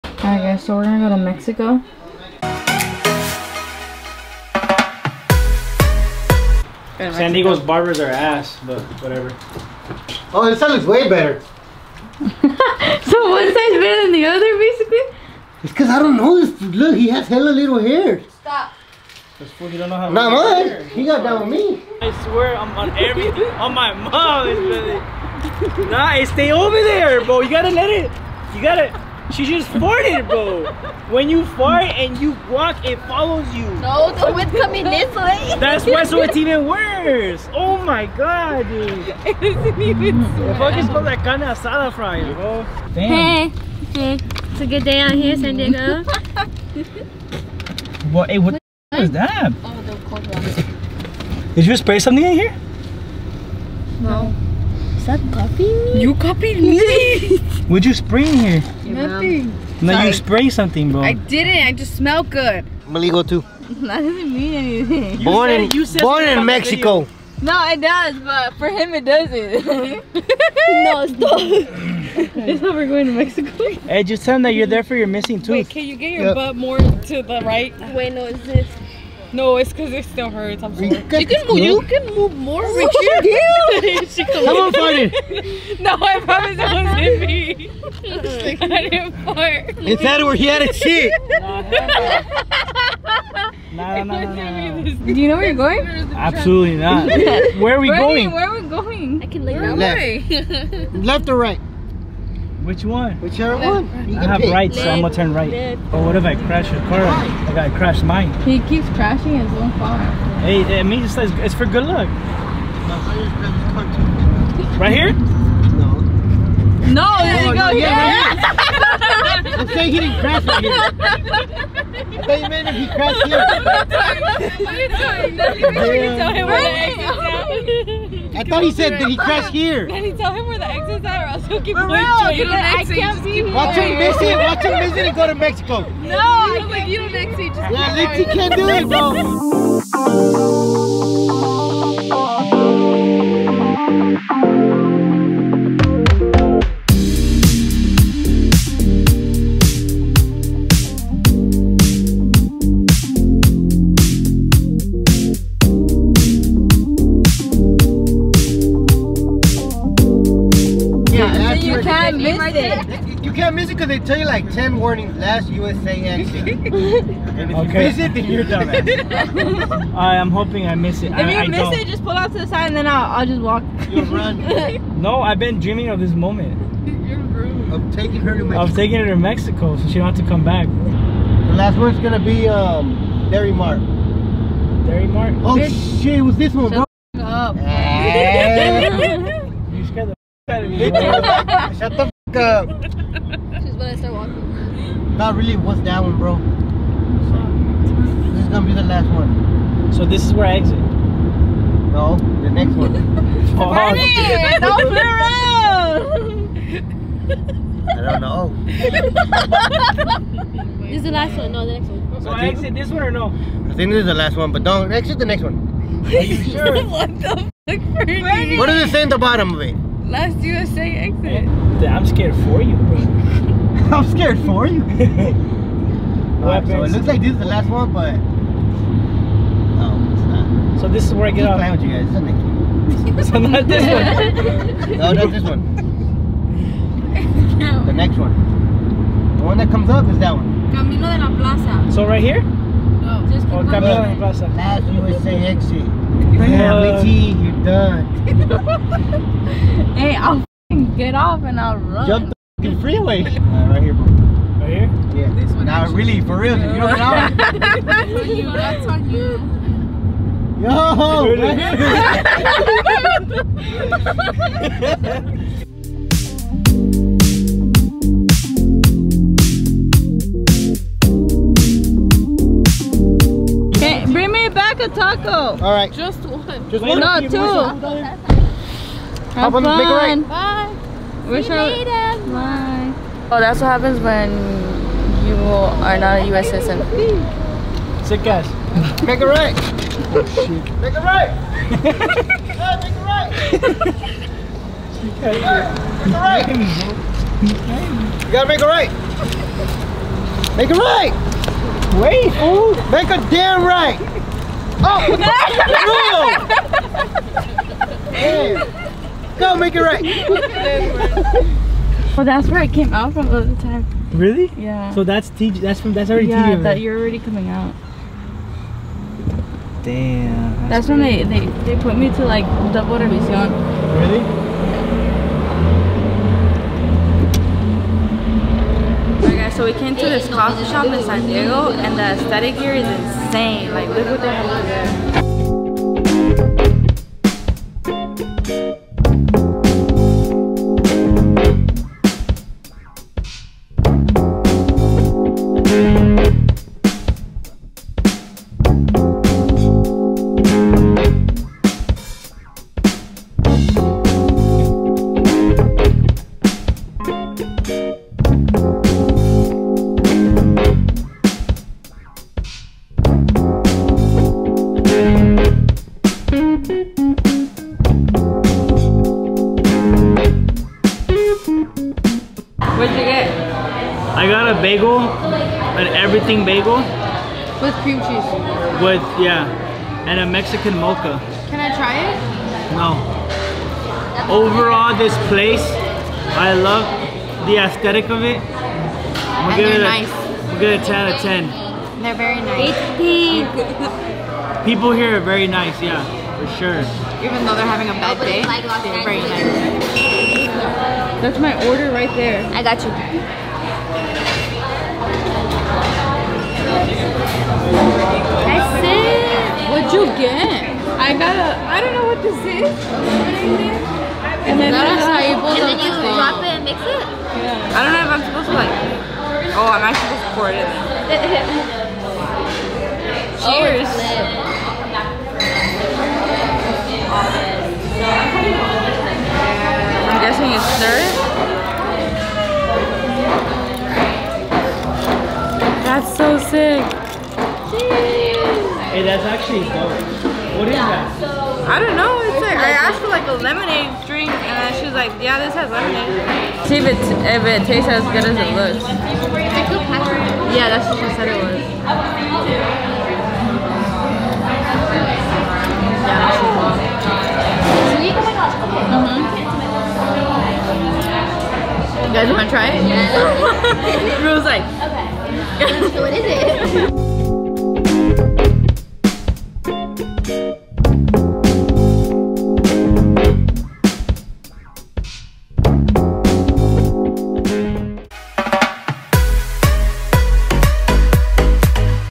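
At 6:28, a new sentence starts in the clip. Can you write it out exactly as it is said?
I'm and they're it a, nice.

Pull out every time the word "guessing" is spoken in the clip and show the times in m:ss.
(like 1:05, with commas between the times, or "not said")
7:10.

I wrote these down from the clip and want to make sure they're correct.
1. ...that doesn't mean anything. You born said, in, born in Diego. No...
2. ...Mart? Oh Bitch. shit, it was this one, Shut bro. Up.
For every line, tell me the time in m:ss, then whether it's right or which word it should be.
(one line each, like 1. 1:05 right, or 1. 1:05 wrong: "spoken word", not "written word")
1. 1:03 wrong: "Mexico", not "Diego"
2. 3:05 right.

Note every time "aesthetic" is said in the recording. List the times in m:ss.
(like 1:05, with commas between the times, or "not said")
5:32, 6:27.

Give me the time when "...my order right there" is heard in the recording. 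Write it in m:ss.
6:41.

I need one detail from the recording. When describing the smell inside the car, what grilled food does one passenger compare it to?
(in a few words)
Carne asada.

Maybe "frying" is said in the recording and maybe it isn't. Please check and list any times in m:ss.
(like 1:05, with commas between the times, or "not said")
0:41.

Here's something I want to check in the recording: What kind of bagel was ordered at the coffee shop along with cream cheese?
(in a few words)
Nothing bagel.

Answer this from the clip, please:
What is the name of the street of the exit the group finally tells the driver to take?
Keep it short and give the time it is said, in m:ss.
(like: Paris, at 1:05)
Camino de la Plaza, at 4:00.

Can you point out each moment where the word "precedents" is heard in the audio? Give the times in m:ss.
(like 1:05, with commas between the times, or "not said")
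not said.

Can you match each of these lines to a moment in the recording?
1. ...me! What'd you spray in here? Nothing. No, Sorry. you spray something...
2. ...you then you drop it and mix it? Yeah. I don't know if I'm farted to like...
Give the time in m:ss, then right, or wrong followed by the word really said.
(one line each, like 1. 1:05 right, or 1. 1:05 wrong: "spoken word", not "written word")
1. 0:56 right
2. 6:55 wrong: "supposed", not "farted".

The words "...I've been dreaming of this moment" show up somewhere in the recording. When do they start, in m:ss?
2:55.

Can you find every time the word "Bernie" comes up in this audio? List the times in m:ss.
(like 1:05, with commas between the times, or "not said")
3:23, 3:37.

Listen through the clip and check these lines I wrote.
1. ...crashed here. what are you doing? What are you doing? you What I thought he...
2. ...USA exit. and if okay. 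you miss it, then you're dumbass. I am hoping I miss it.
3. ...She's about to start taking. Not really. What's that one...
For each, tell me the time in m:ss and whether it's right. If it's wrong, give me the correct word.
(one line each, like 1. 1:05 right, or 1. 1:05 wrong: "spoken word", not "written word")
1. 2:02 right
2. 2:45 right
3. 3:12 wrong: "walking", not "taking".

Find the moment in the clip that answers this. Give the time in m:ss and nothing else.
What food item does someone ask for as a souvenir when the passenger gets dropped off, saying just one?
4:34.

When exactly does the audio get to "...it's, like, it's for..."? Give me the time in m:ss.
1:51.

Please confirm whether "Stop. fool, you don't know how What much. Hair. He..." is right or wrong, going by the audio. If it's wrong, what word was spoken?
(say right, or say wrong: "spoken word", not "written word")
wrong: "Not", not "What".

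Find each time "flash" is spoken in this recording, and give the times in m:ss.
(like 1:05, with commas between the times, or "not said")
not said.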